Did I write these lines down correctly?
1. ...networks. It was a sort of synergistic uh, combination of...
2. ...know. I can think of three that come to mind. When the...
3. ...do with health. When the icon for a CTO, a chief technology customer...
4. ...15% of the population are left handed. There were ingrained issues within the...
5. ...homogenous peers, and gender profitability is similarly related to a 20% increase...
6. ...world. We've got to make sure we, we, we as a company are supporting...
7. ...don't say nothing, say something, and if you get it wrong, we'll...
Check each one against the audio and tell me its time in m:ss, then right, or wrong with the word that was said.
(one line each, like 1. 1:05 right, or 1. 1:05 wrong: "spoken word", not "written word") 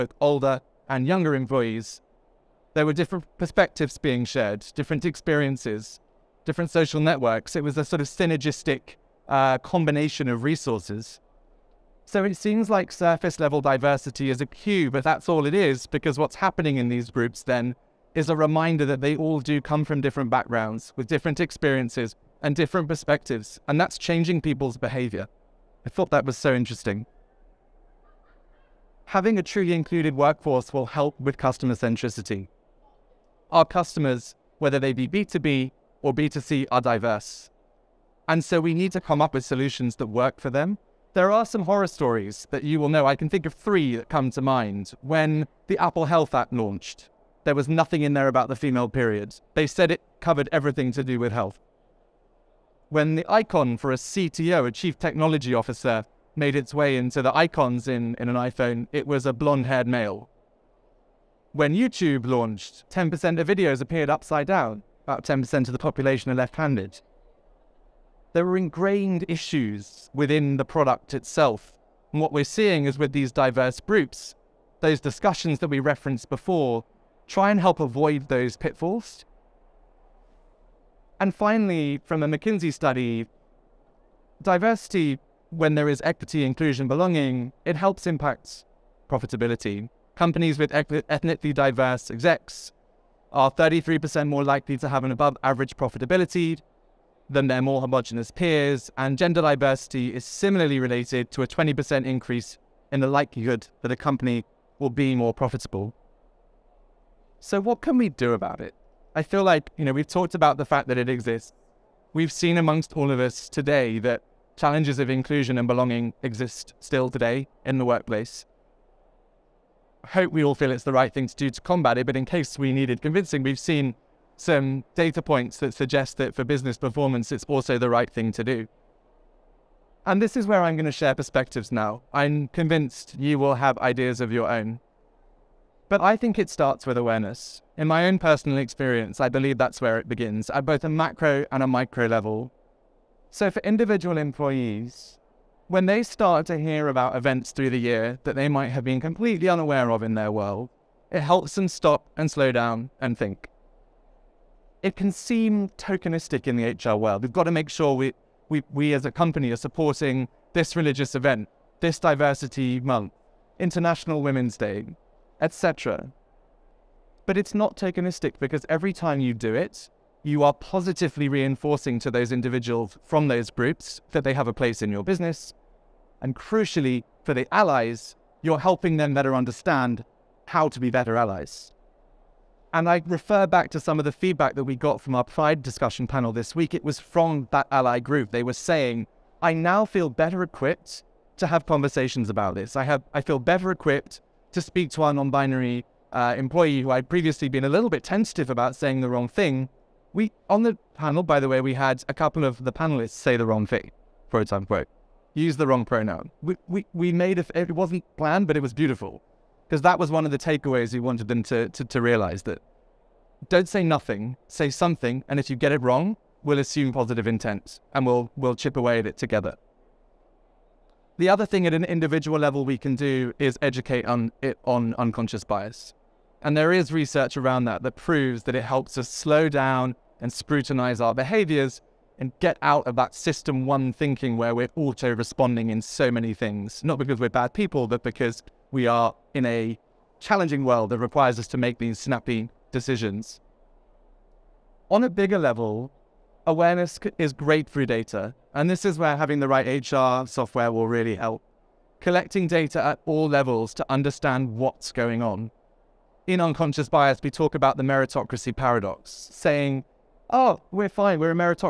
1. 0:06 right
2. 0:42 right
3. 0:51 wrong: "officer", not "customer"
4. 1:05 wrong: "10", not "15"
5. 1:37 wrong: "diversity", not "profitability"
6. 2:36 right
7. 3:33 right.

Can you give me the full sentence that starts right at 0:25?
I thought that was so interesting.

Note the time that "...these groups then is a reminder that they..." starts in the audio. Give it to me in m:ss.
0:16.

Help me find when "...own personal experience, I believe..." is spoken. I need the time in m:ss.
2:18.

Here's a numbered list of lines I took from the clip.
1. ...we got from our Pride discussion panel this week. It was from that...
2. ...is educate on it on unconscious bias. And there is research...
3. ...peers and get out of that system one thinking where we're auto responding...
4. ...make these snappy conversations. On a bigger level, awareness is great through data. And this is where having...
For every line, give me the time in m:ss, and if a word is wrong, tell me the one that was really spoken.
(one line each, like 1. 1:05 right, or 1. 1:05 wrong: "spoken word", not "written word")
1. 3:04 right
2. 3:43 right
3. 3:51 wrong: "behaviors", not "peers"
4. 4:01 wrong: "decisions", not "conversations".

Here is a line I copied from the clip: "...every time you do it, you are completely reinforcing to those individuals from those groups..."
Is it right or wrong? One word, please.
wrong.